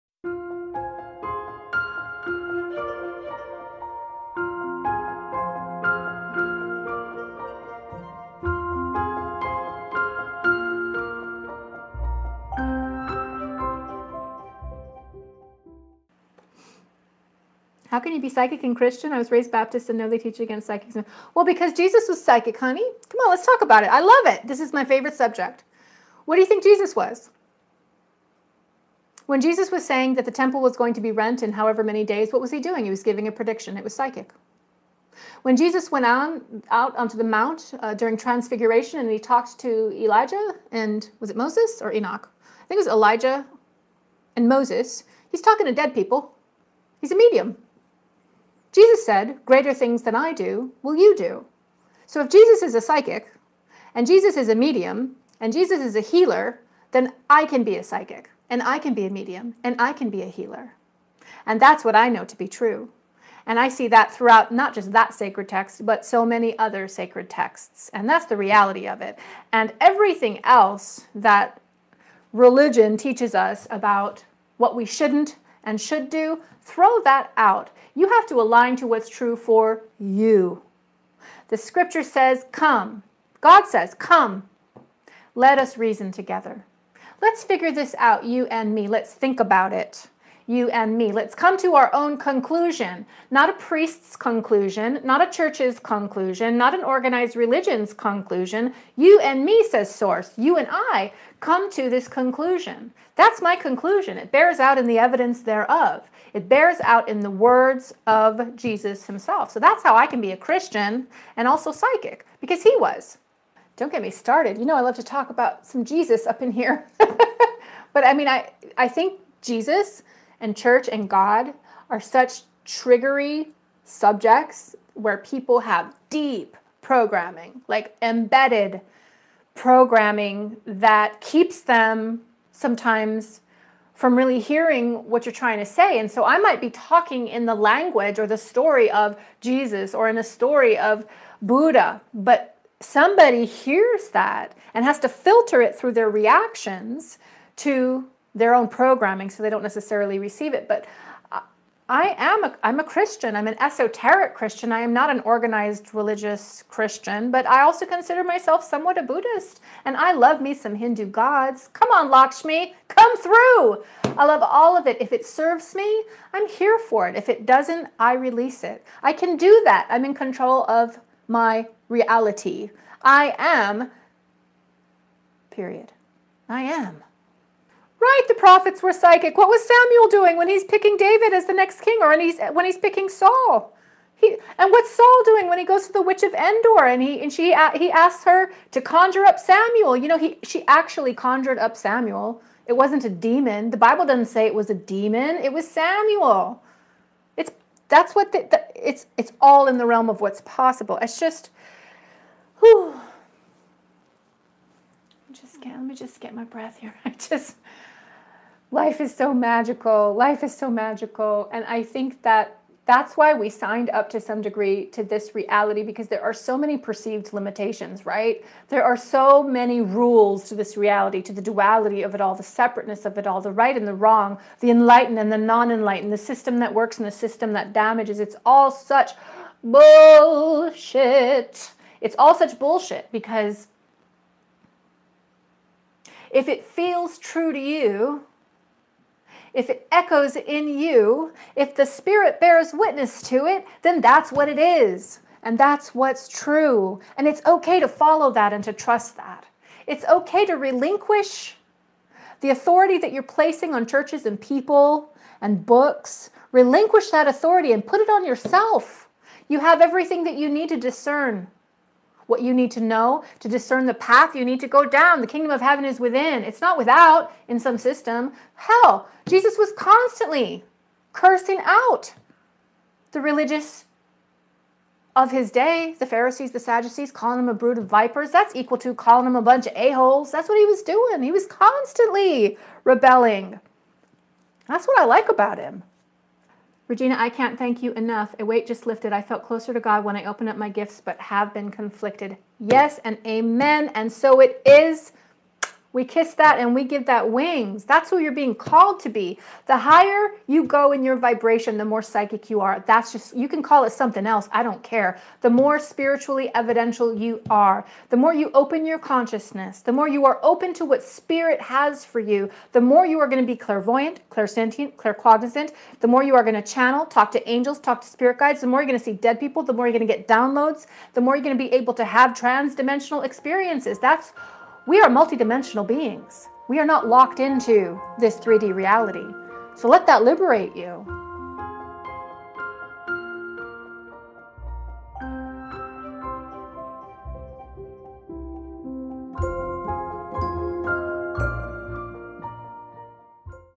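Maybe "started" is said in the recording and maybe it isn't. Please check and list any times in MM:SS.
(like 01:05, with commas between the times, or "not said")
01:54.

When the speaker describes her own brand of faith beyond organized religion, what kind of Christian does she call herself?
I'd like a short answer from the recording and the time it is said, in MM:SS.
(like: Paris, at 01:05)
Esoteric Christian, at 02:33.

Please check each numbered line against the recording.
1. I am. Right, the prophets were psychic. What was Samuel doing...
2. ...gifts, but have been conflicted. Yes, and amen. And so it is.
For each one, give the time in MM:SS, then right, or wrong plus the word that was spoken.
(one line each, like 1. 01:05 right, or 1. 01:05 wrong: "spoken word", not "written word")
1. 02:56 right
2. 04:50 right.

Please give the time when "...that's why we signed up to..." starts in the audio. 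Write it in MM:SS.
03:32.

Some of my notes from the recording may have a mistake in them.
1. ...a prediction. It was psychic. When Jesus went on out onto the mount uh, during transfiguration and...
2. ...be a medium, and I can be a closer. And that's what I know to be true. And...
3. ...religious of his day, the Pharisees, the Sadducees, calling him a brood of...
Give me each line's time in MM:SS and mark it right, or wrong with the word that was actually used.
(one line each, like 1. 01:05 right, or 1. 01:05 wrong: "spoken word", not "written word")
1. 00:33 right
2. 00:58 wrong: "healer", not "closer"
3. 04:33 right.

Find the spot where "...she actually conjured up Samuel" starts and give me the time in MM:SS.
03:10.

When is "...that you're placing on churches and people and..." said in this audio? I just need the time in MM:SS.
04:12.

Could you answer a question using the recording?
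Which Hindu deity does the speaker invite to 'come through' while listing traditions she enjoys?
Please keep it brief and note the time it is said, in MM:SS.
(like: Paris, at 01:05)
Lakshmi, at 02:42.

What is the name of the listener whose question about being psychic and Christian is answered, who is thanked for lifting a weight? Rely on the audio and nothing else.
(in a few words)
Regina.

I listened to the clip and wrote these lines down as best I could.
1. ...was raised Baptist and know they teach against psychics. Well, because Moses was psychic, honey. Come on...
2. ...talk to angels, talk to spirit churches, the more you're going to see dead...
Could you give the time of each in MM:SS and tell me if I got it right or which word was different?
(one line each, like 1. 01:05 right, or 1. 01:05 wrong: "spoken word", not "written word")
1. 00:19 wrong: "Jesus", not "Moses"
2. 05:17 wrong: "guides", not "churches".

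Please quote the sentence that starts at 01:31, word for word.
Let's come to our own conclusion, not a priest's conclusion, not a church's conclusion, not an organized religion's conclusion.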